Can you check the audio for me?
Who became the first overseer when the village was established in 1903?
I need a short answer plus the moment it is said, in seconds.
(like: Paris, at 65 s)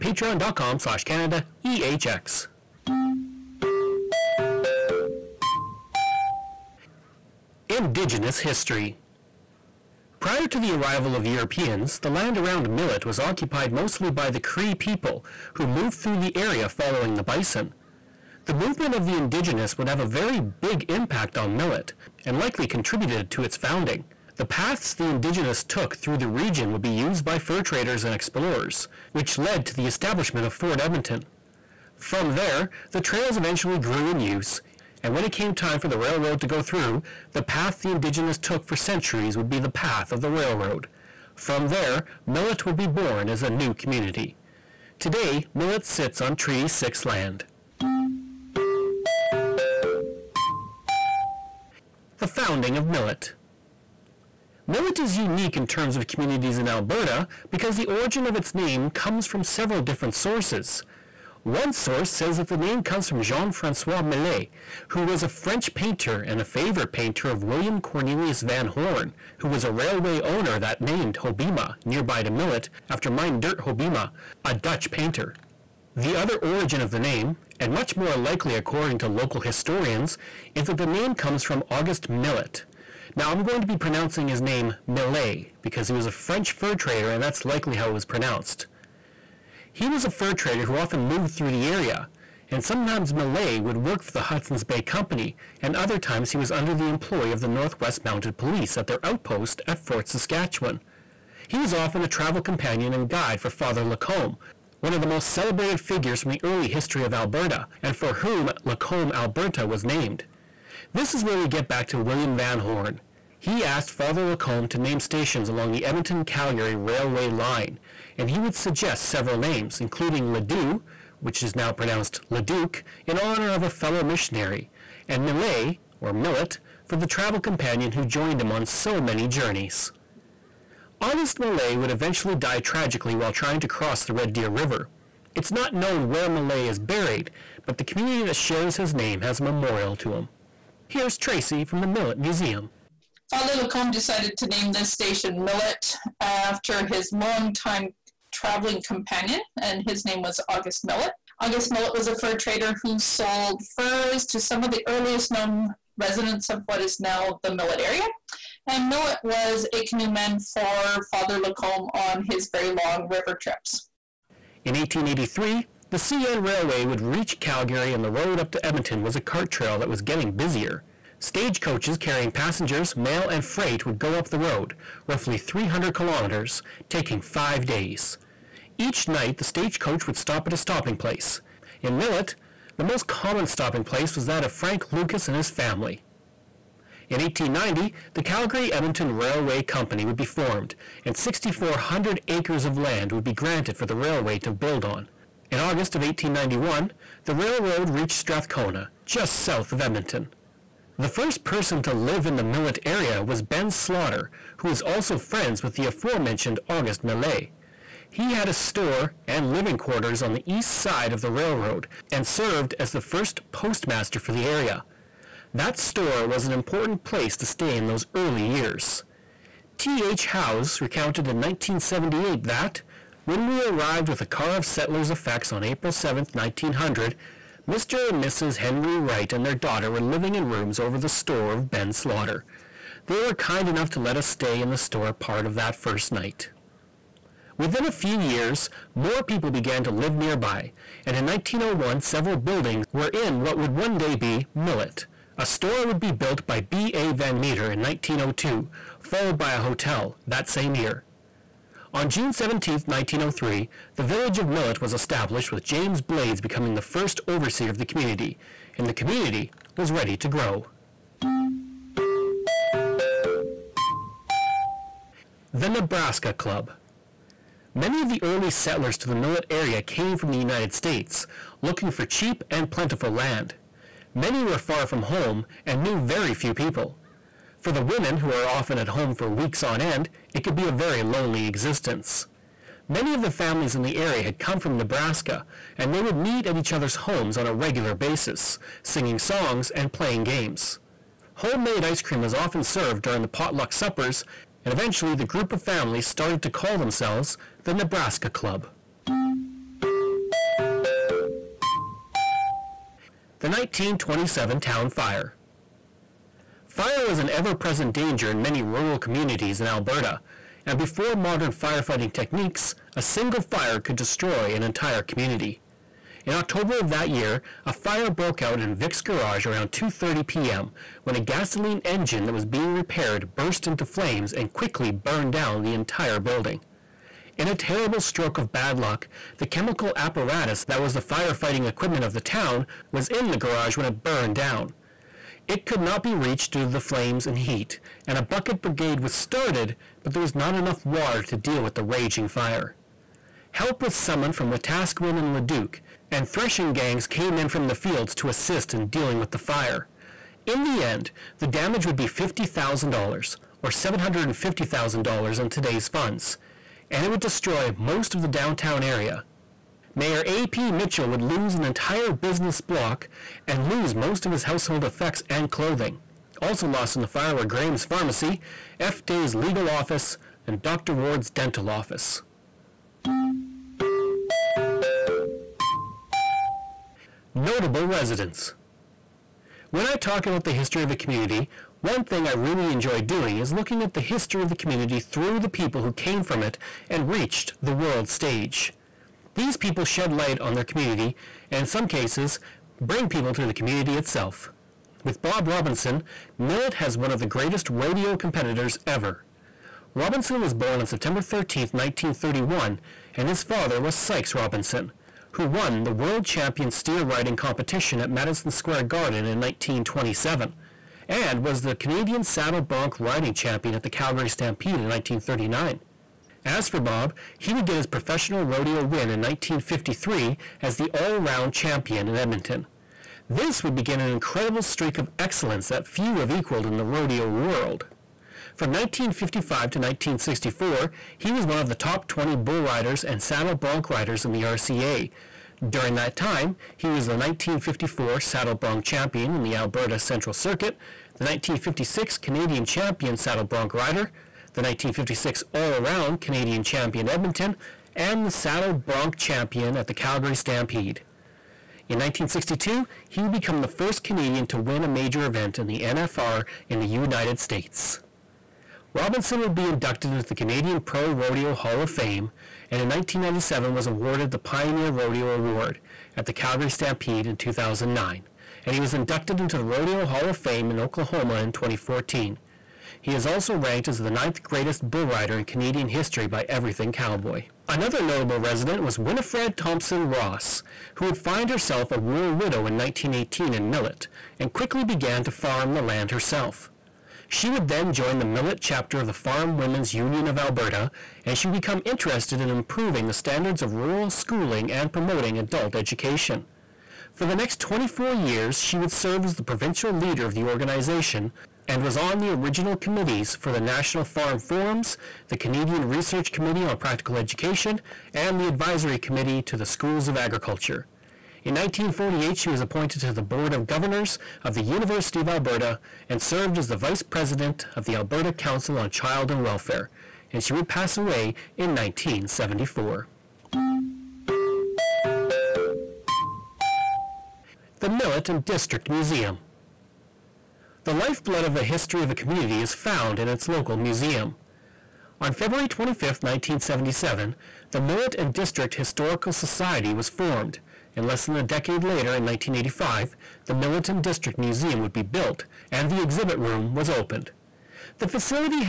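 James Blades, at 255 s.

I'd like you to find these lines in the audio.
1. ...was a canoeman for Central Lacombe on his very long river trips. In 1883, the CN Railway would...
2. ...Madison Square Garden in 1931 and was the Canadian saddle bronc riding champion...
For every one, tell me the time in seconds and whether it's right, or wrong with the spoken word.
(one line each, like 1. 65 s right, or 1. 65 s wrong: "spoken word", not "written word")
1. 159 s wrong: "Father", not "Central"
2. 408 s wrong: "1927", not "1931".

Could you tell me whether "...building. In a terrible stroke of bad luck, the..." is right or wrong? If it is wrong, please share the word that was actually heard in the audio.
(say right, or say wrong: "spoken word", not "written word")
right.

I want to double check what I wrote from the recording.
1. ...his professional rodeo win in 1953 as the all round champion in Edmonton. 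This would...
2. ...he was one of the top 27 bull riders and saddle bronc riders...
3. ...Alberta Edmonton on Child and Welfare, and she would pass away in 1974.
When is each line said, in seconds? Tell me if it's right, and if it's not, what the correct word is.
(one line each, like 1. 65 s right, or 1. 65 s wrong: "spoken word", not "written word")
1. 417 s right
2. 431 s wrong: "20", not "27"
3. 517 s wrong: "Council", not "Edmonton".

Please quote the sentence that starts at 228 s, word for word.
Henry Wright and their daughter were living in rooms over the store of Ben Slaughter.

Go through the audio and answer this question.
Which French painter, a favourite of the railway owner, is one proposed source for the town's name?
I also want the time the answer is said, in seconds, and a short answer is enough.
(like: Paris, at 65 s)
Jean Francois Millet, at 63 s.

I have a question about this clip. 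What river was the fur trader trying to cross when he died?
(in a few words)
Red Deer River.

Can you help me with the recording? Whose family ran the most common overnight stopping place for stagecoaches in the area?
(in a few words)
Frank Lucas.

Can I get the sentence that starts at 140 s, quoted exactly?
Here's Tracy from the Millet Museum.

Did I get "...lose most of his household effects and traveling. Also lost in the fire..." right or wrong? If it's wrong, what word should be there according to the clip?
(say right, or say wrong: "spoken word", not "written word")
wrong: "clothing", not "traveling".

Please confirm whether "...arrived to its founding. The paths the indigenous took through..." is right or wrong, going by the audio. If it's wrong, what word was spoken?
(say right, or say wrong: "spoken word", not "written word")
wrong: "contributed", not "arrived".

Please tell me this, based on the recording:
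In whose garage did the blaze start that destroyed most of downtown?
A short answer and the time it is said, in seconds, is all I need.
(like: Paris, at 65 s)
Vic's garage, at 318 s.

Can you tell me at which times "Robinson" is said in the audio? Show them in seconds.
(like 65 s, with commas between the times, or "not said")
395 s, 399 s, 404 s, 458 s.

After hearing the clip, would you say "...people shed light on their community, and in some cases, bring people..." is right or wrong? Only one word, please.
right.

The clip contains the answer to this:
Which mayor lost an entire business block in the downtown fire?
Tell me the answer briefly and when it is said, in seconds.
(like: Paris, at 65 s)
A.P. Mitchell, at 360 s.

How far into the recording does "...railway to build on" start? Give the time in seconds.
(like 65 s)
193 s.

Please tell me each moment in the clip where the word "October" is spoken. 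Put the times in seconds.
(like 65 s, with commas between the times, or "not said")
316 s.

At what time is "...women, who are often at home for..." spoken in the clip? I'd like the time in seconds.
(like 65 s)
277 s.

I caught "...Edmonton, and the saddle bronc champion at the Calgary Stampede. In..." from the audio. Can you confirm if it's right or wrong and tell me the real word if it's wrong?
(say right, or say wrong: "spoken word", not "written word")
right.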